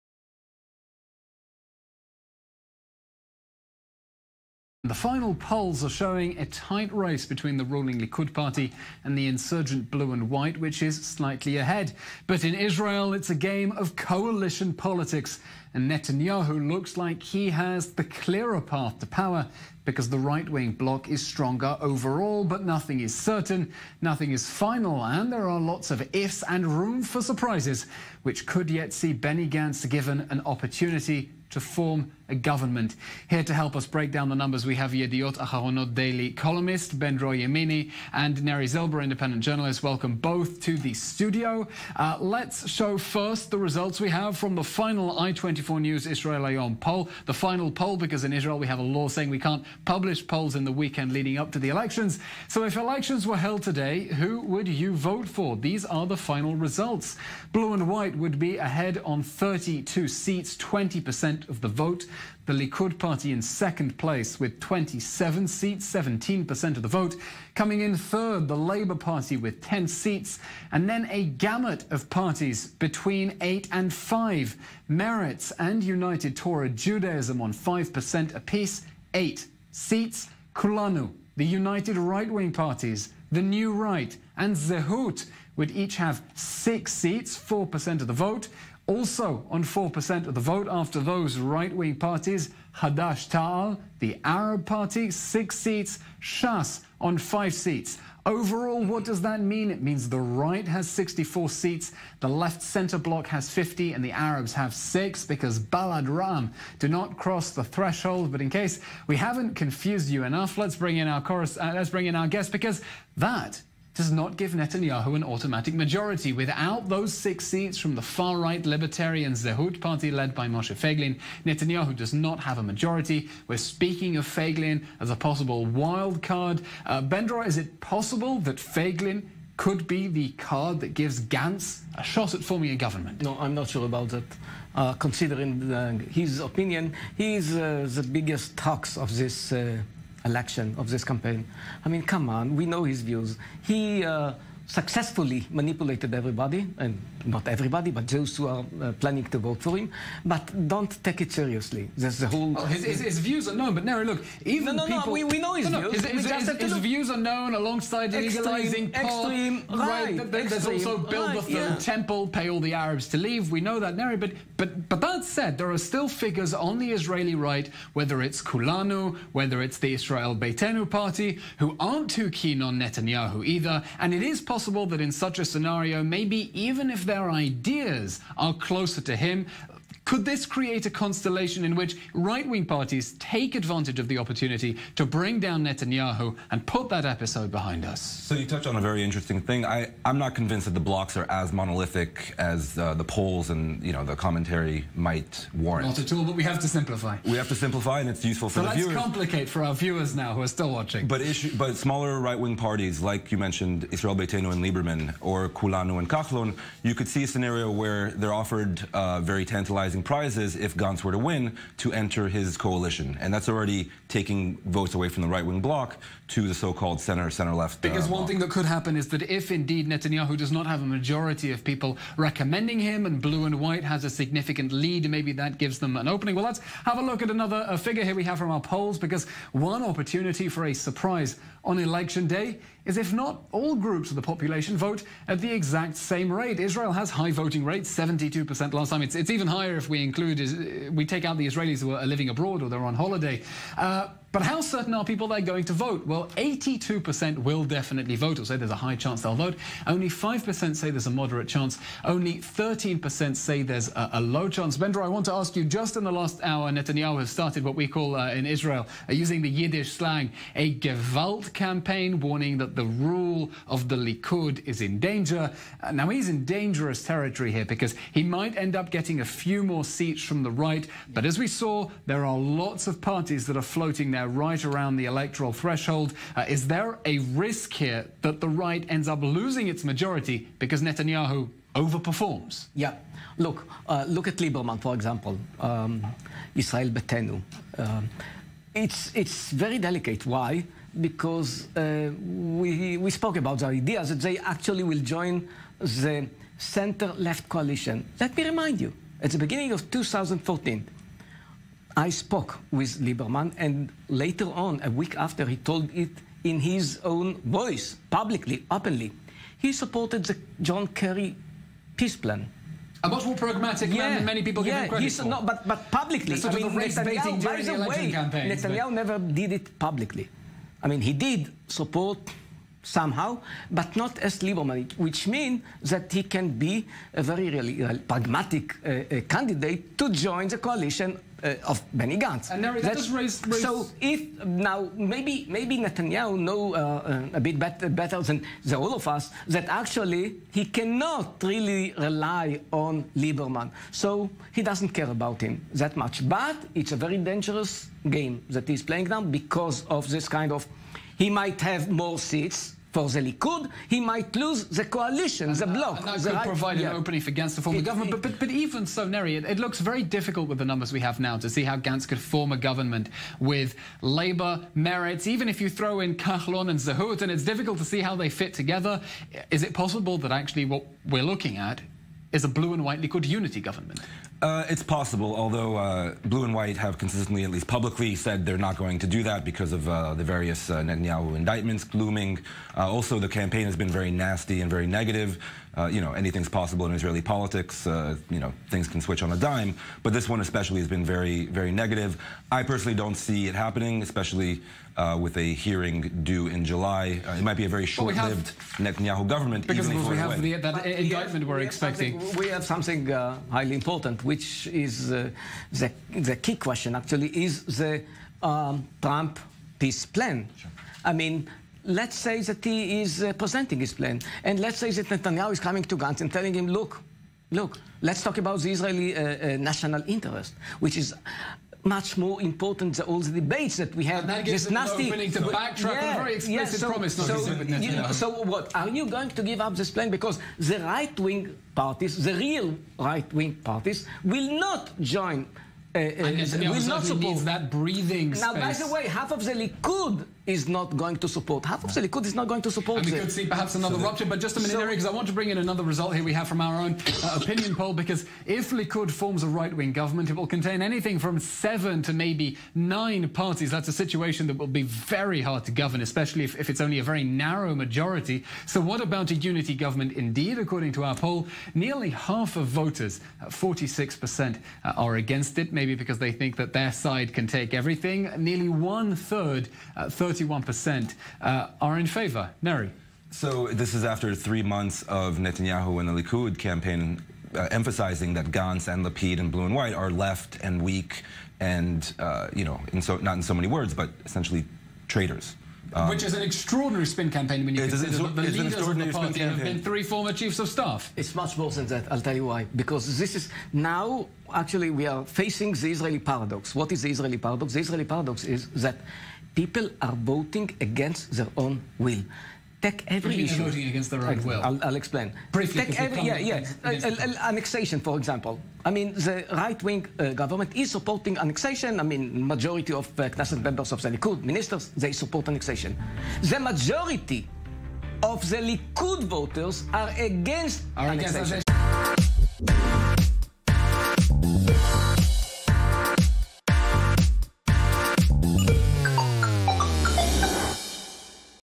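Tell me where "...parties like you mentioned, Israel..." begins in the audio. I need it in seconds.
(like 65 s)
202 s.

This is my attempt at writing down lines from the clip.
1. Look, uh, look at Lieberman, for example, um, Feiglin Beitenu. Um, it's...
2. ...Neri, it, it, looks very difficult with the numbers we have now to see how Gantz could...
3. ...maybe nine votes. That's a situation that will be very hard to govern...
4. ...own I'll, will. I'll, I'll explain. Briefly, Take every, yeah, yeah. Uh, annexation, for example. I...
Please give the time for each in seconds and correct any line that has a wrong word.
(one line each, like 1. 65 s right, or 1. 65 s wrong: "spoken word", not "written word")
1. 283 s wrong: "Israel", not "Feiglin"
2. 359 s right
3. 452 s wrong: "parties", not "votes"
4. 504 s right.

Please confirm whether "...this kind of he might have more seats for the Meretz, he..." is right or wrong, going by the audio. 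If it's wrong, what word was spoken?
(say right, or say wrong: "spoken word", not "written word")
wrong: "Likud", not "Meretz".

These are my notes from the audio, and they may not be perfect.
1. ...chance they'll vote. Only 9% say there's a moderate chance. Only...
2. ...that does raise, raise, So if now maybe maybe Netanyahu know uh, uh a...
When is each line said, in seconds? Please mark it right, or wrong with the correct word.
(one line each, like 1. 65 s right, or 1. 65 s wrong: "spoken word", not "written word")
1. 248 s wrong: "5", not "9"
2. 332 s right.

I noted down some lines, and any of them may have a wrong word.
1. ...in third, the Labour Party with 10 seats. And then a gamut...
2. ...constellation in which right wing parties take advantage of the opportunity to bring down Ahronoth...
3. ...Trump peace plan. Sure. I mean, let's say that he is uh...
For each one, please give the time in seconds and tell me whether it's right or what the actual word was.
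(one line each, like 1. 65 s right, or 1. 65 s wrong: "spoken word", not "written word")
1. 67 s right
2. 180 s wrong: "Netanyahu", not "Ahronoth"
3. 409 s right.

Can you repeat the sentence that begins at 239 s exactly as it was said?
It's, it's even higher if we include, we take out the Israelis who are living abroad or they're on holiday.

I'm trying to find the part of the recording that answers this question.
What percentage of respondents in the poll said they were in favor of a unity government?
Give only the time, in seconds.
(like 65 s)
470 s.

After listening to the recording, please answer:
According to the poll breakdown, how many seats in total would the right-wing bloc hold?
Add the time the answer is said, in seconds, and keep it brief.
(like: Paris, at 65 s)
64, at 100 s.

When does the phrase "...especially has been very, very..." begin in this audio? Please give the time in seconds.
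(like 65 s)
390 s.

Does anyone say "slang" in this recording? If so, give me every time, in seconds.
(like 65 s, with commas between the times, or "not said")
259 s.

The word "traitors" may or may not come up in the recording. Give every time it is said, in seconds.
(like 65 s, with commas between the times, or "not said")
485 s.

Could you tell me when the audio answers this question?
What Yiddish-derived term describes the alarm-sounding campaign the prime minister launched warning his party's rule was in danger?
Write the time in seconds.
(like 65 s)
260 s.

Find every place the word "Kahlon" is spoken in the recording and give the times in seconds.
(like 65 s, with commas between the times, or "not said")
206 s, 366 s.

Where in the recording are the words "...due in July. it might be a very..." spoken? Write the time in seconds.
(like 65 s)
396 s.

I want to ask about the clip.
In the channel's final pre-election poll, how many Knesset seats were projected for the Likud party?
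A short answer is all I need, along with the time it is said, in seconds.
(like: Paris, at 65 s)
27, at 64 s.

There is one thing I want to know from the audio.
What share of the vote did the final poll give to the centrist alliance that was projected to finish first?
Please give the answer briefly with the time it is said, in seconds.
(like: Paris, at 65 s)
20%, at 60 s.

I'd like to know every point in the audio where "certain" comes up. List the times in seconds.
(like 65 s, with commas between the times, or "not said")
23 s, 244 s.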